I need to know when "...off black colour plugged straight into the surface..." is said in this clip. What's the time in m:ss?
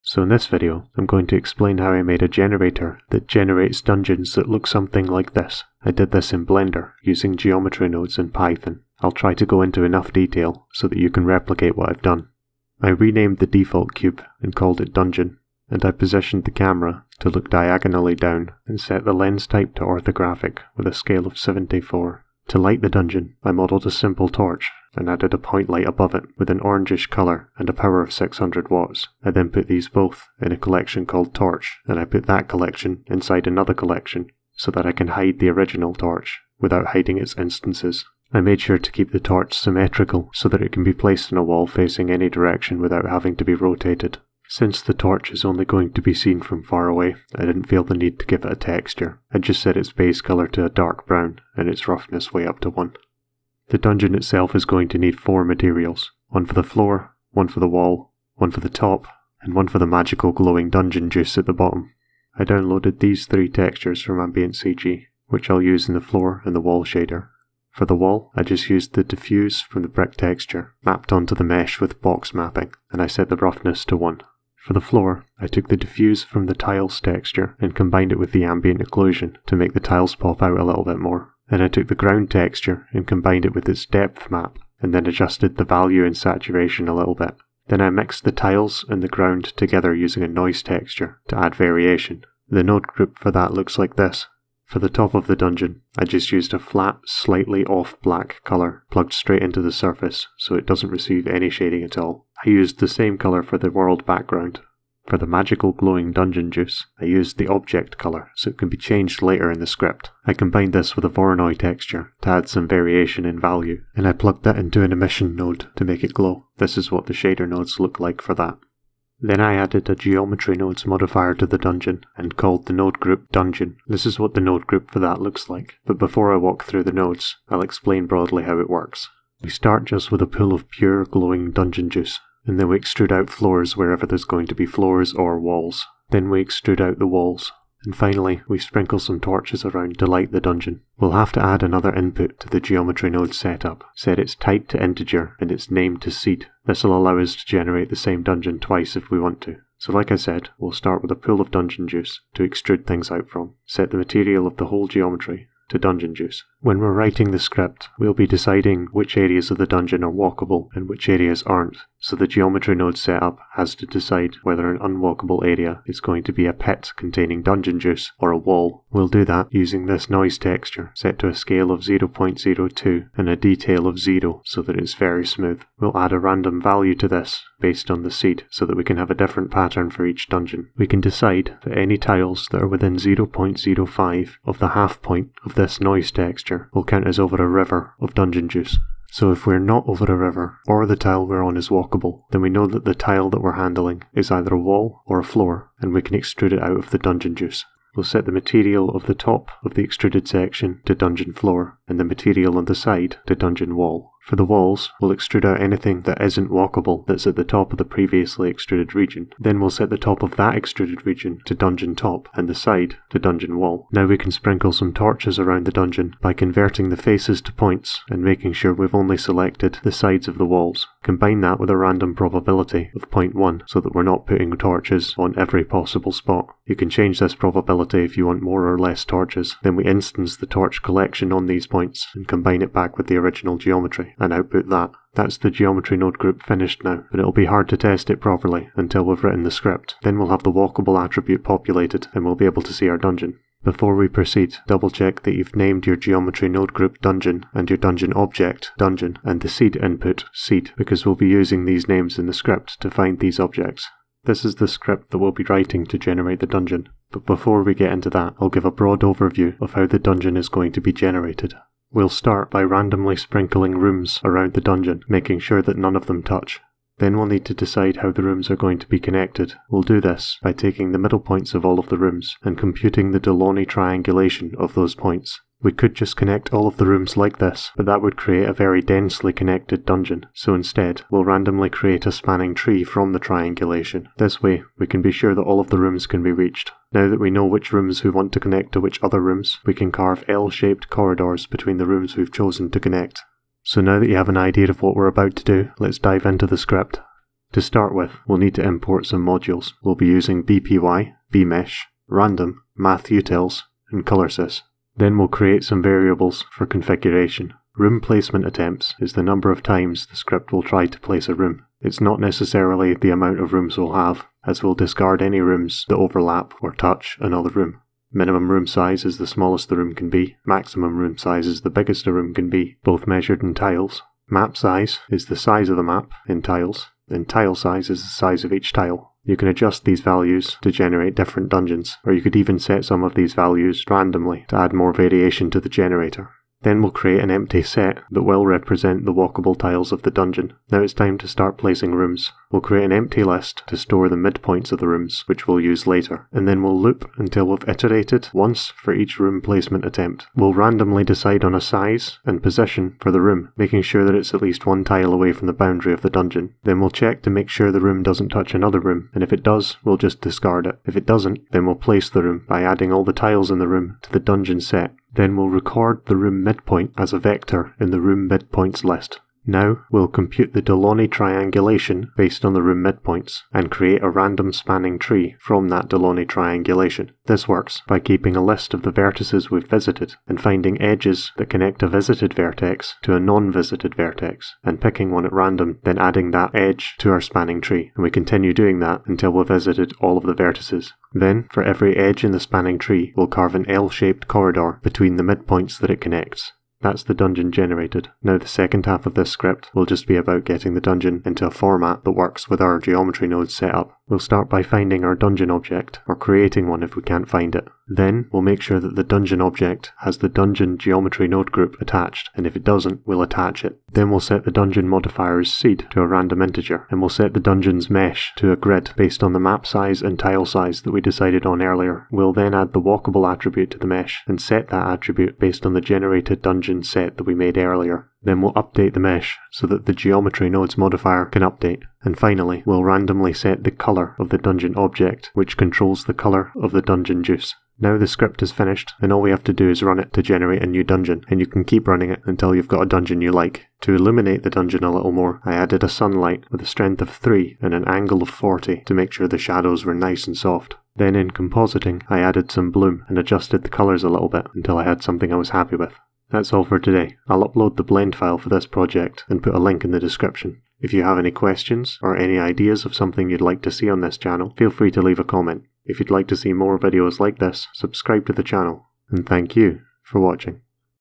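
1:37.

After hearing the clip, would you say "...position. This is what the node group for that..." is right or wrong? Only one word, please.
wrong.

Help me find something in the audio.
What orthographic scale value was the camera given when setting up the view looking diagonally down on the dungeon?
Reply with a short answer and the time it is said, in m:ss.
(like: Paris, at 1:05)
74, at 0:21.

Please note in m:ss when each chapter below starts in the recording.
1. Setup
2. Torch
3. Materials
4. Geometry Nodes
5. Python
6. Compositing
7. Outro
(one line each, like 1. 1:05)
1. 0:12
2. 0:22
3. 0:53
4. 1:59
5. 4:14
6. 7:23
7. 7:36.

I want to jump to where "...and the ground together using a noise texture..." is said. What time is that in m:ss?
1:28.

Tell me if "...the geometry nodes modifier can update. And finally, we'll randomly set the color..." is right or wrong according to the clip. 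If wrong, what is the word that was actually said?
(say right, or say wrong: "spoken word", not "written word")
right.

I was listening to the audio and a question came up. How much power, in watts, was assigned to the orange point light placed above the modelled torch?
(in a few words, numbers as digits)
600 watts.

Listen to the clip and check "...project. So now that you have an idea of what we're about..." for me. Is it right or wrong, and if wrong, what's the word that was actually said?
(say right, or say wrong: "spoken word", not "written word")
wrong: "connect", not "project".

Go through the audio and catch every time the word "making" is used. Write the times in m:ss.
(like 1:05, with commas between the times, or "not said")
3:38, 4:25, 5:53.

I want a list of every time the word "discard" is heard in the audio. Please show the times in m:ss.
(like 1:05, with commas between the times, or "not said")
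5:14, 6:00.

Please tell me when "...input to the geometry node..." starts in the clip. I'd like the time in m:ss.
2:21.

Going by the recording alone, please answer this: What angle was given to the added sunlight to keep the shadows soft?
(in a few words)
40.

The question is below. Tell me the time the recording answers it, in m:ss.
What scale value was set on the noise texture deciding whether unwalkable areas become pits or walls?
2:51.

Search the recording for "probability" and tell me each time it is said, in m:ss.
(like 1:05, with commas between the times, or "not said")
3:42, 3:47.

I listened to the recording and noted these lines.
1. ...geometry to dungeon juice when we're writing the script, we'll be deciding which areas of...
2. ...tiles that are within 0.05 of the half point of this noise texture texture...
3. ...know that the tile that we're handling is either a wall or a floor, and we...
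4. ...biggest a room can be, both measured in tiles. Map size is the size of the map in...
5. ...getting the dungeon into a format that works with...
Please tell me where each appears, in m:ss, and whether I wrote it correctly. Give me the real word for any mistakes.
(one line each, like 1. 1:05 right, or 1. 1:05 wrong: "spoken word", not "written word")
1. 2:34 right
2. 3:01 right
3. 3:12 right
4. 5:21 right
5. 6:40 right.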